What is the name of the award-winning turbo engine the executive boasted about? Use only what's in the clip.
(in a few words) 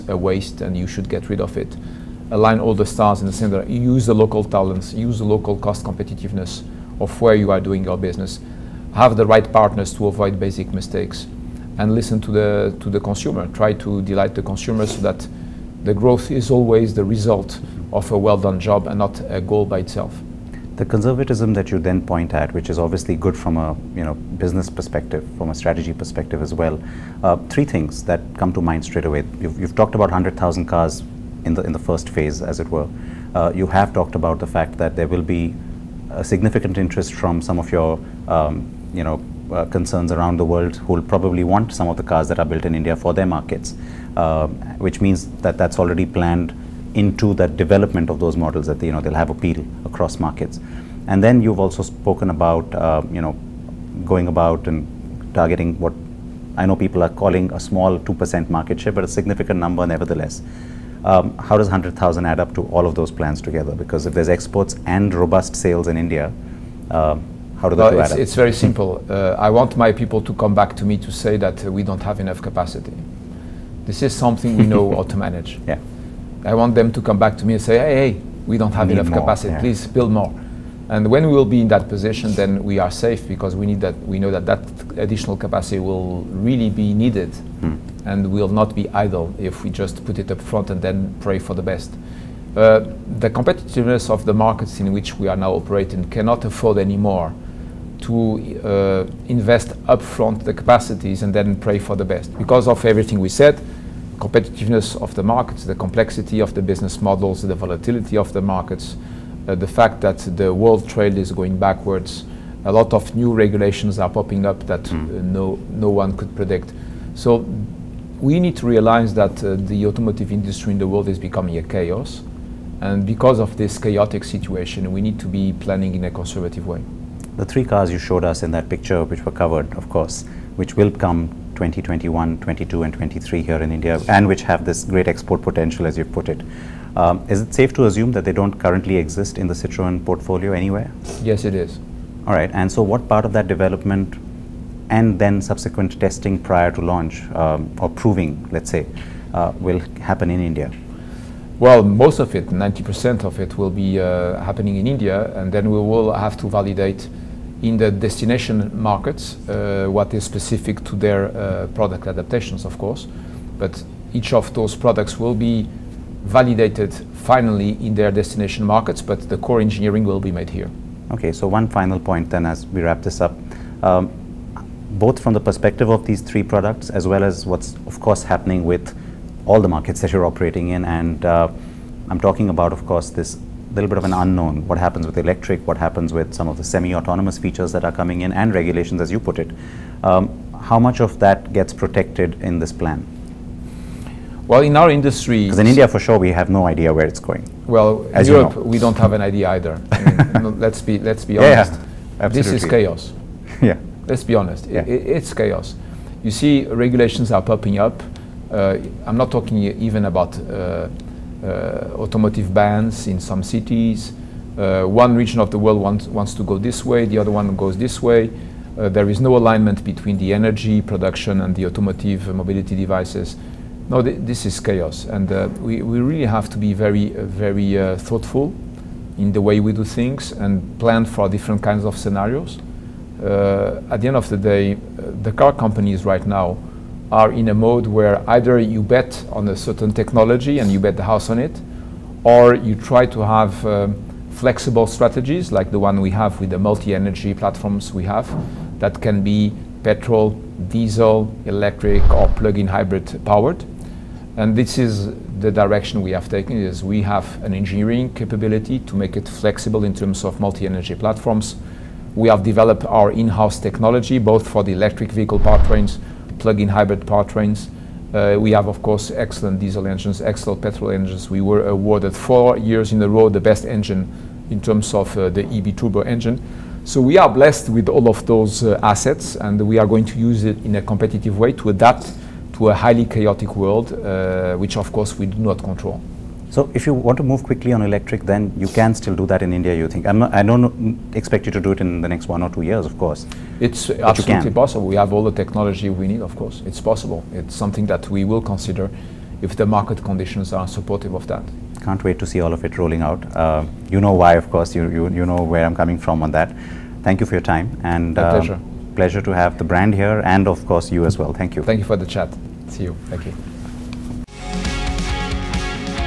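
EB turbo.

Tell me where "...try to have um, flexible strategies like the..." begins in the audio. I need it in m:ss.
4:02.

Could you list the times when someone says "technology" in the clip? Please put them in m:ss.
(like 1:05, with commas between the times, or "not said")
3:59, 4:23, 4:55.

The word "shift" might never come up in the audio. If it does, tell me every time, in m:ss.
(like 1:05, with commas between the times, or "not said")
not said.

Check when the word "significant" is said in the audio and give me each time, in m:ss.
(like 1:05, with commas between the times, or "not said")
0:36, 0:59.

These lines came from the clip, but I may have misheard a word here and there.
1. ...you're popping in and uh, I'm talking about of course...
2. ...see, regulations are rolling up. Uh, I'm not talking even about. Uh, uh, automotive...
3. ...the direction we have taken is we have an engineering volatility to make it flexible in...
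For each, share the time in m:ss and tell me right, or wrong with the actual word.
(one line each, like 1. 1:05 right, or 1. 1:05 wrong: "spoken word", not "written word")
1. 3:00 wrong: "operating", not "popping"
2. 3:26 wrong: "popping", not "rolling"
3. 4:15 wrong: "capability", not "volatility".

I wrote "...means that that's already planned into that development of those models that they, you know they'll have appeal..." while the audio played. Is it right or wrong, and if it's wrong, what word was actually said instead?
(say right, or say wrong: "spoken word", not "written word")
right.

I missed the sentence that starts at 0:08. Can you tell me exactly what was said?
Have the right partners to avoid basic mistakes, and listen to the to the consumer.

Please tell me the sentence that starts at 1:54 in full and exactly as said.
uh, no, no one could predict.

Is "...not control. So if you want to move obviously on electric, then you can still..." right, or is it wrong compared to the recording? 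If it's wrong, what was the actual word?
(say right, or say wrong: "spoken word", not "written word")
wrong: "quickly", not "obviously".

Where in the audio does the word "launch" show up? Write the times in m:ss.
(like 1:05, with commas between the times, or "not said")
2:26.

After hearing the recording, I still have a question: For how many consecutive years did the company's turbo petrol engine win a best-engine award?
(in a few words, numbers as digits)
4.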